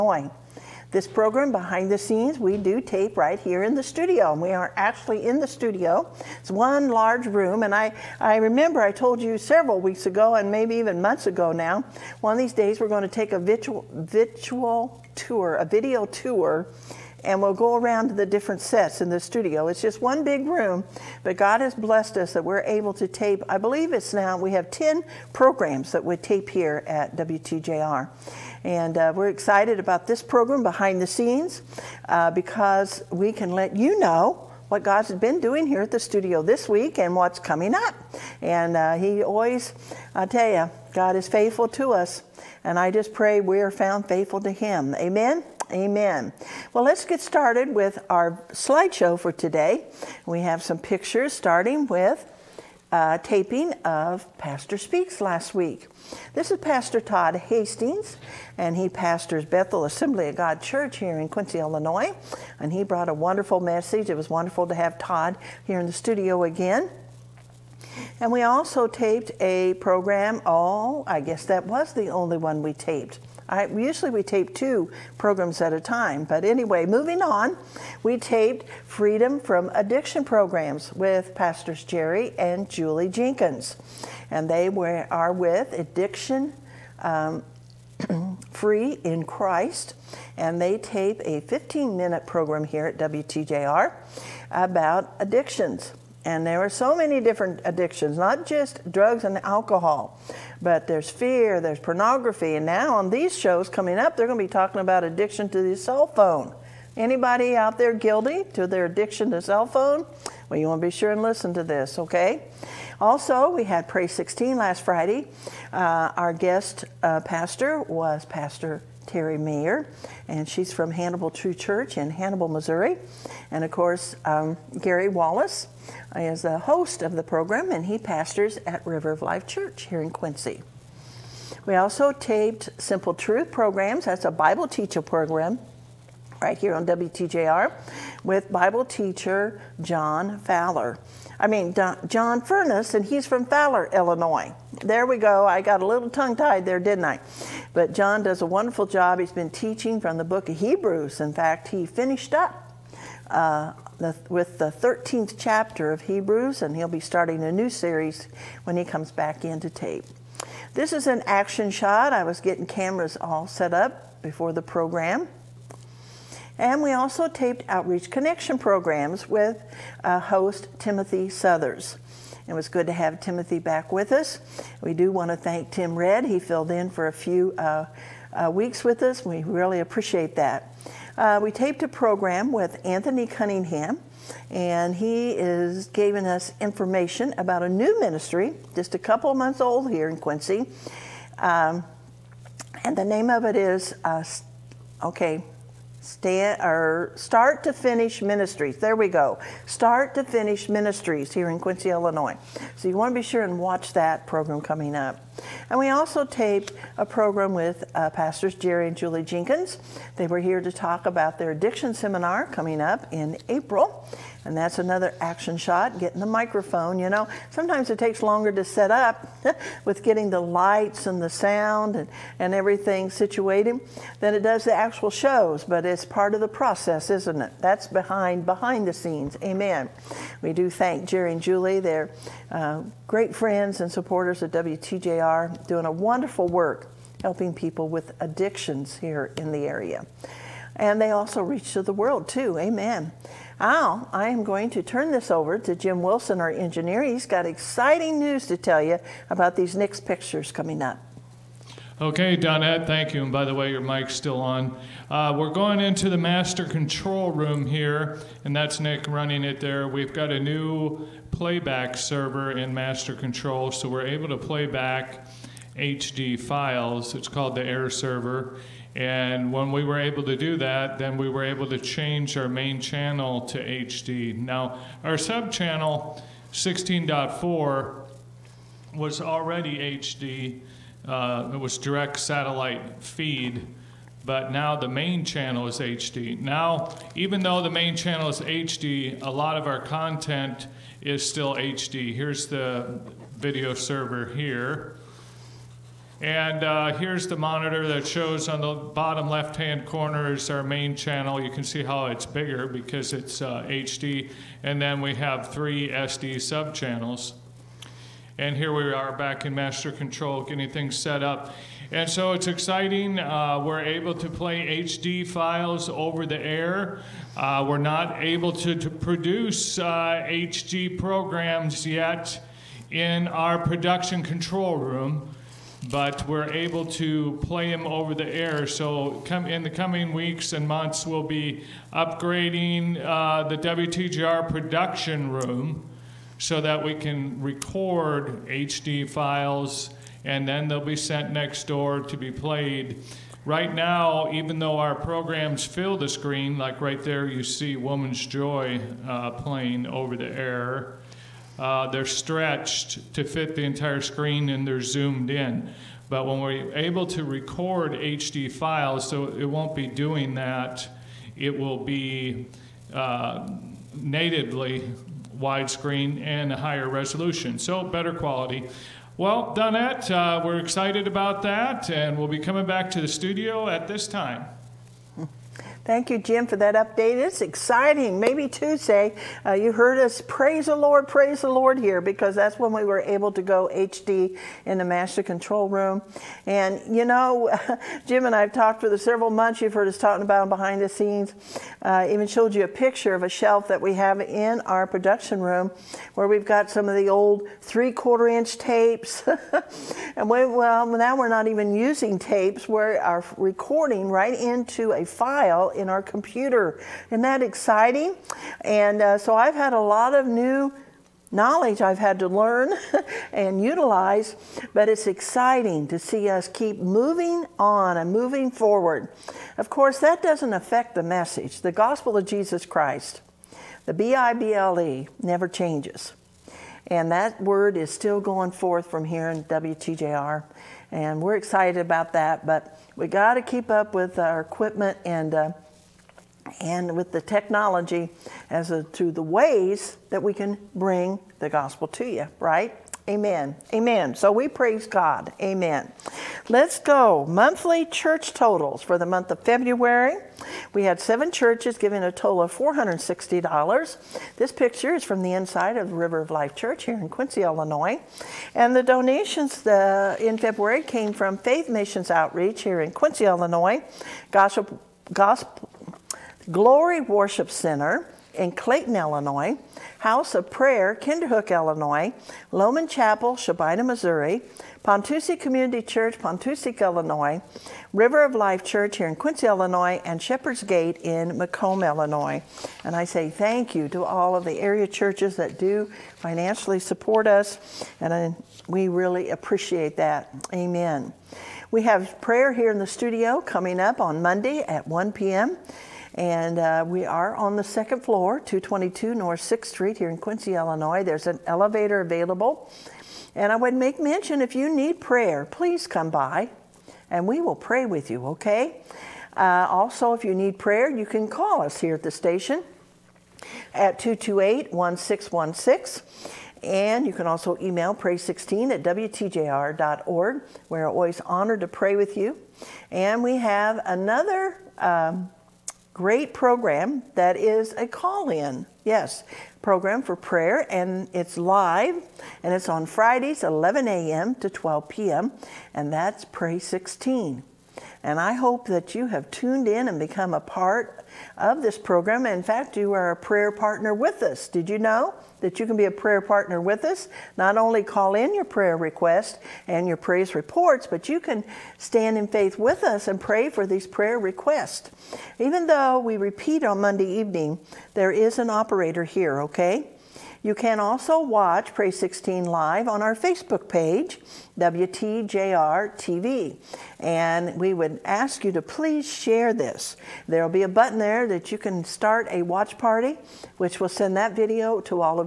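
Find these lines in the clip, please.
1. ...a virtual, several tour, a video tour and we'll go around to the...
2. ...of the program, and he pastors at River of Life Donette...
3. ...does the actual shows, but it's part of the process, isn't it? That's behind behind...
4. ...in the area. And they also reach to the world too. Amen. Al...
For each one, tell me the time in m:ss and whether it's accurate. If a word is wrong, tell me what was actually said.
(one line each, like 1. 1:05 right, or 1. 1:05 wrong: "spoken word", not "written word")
1. 0:13 wrong: "virtual", not "several"
2. 2:07 wrong: "Church", not "Donette"
3. 3:44 right
4. 3:59 right.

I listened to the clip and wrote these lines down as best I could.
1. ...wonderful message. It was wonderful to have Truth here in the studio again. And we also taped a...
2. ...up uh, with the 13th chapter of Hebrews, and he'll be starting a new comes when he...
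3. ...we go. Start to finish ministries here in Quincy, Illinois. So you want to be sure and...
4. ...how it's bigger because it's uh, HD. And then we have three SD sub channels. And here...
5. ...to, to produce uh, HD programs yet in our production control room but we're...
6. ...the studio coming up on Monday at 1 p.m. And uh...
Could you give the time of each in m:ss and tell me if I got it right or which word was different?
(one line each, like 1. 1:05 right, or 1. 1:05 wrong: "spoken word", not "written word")
1. 1:03 wrong: "Todd", not "Truth"
2. 2:32 wrong: "series", not "comes"
3. 3:18 right
4. 5:01 right
5. 5:18 right
6. 8:12 right.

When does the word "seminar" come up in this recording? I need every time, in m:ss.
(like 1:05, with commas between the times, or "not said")
3:31.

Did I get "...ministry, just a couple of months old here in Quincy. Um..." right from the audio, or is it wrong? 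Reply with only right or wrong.
right.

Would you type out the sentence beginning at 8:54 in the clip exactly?
to 12 p.m., and that's Pray 16.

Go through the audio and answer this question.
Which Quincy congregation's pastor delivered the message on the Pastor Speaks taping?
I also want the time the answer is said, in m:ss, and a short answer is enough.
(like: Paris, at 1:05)
Bethel Assembly of God, at 0:59.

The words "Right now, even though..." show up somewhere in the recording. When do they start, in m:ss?
5:43.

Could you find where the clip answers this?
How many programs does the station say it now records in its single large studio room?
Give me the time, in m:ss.
0:24.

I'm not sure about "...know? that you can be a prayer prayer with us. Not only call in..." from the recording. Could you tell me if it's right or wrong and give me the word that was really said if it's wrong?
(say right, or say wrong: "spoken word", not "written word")
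wrong: "partner", not "prayer".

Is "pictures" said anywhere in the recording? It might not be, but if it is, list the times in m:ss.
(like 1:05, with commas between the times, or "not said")
0:50, 4:10, 6:32, 7:34.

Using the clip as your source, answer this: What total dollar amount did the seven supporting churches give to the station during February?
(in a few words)
$460.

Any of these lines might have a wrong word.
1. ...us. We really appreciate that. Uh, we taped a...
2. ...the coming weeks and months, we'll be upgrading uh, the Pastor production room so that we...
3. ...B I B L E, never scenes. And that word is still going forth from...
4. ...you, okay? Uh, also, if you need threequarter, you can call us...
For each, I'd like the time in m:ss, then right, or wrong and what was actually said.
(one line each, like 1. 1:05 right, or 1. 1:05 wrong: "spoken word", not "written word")
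1. 2:59 right
2. 5:29 wrong: "WTJR", not "Pastor"
3. 7:03 wrong: "changes", not "scenes"
4. 8:28 wrong: "prayer", not "threequarter".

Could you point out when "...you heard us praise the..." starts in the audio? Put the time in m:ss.
6:19.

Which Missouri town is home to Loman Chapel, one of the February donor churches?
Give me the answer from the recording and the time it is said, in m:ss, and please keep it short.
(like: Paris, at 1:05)
Shelbina, at 7:53.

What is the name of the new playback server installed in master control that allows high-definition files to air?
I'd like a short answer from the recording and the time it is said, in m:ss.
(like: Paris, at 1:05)
Air Server, at 4:27.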